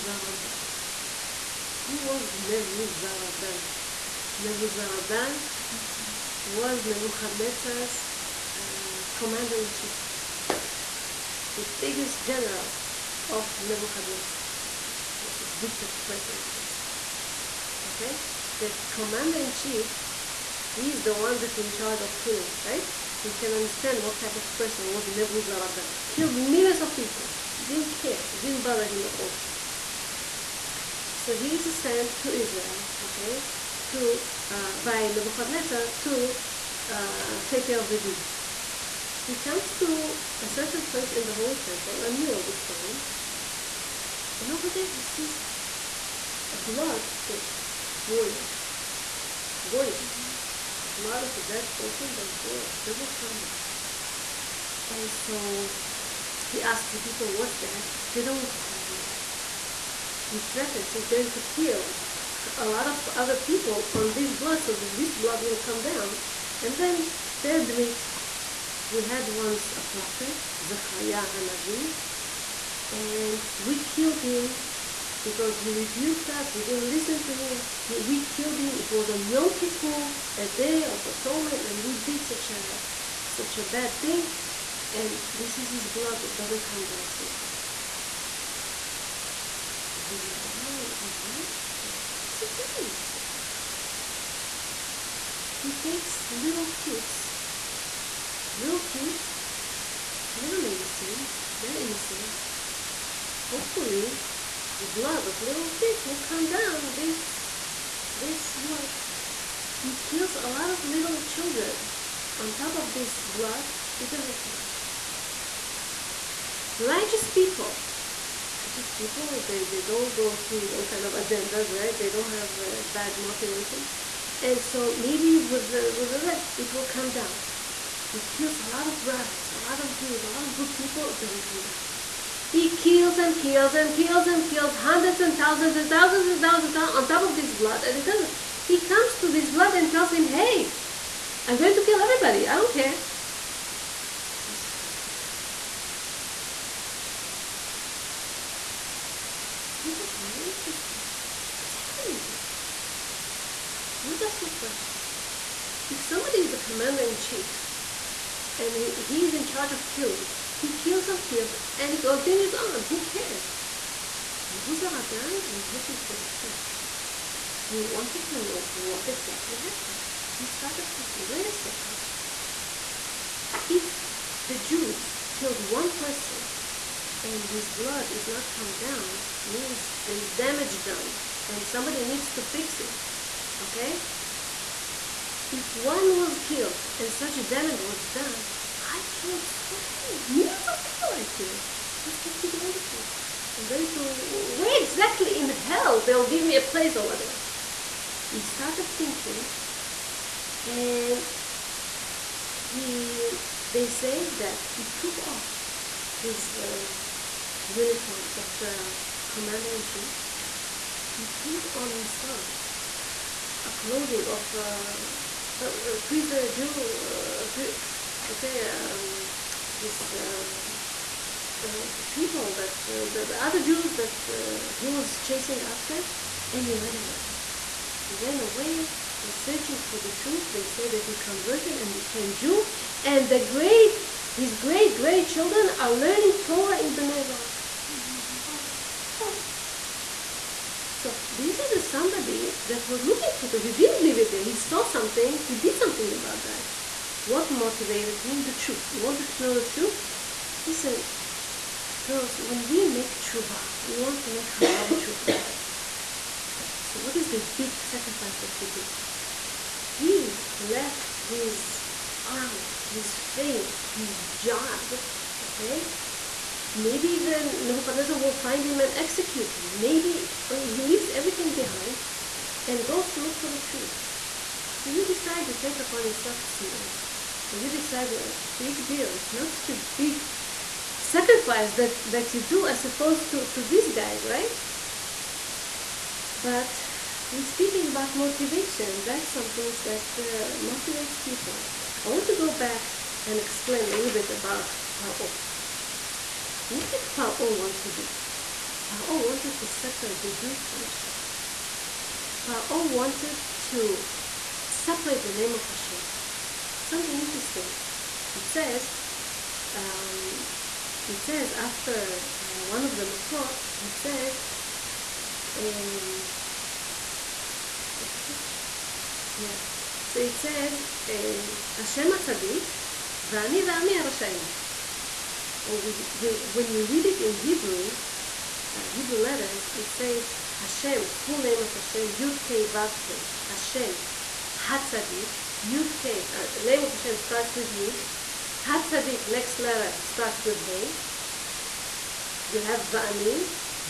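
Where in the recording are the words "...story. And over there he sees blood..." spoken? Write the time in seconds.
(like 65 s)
42 s.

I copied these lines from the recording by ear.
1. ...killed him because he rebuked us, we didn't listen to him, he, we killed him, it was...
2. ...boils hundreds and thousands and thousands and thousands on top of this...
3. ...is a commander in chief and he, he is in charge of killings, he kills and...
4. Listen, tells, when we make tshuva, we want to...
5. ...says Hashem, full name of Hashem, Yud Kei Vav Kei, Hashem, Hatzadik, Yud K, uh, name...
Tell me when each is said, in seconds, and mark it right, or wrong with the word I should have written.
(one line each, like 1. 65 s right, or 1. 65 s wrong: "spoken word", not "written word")
1. 73 s right
2. 134 s wrong: "kills", not "boils"
3. 156 s right
4. 250 s wrong: "girls", not "tells"
5. 329 s right.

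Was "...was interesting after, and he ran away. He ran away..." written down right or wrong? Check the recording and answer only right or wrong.
wrong.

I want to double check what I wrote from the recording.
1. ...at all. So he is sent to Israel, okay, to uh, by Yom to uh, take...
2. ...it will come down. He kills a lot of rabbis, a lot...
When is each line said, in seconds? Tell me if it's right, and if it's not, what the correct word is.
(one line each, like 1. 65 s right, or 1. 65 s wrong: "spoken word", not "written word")
1. 29 s wrong: "Nebuchadnezzar", not "Yom"
2. 126 s right.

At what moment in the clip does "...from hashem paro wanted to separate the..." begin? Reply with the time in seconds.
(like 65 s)
300 s.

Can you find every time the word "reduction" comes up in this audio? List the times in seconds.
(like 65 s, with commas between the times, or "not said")
not said.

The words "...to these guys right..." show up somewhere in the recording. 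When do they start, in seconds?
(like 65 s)
283 s.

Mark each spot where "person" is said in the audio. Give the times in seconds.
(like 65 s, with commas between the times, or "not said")
16 s, 24 s, 51 s, 175 s.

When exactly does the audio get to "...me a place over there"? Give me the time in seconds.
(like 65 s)
196 s.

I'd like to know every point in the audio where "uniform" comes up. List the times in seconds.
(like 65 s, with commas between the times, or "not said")
207 s.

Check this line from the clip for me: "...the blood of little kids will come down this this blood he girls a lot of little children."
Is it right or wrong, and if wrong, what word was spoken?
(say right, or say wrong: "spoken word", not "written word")
wrong: "kills", not "girls".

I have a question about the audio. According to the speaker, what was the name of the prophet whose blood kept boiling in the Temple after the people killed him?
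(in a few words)
Zechariah Hanavi.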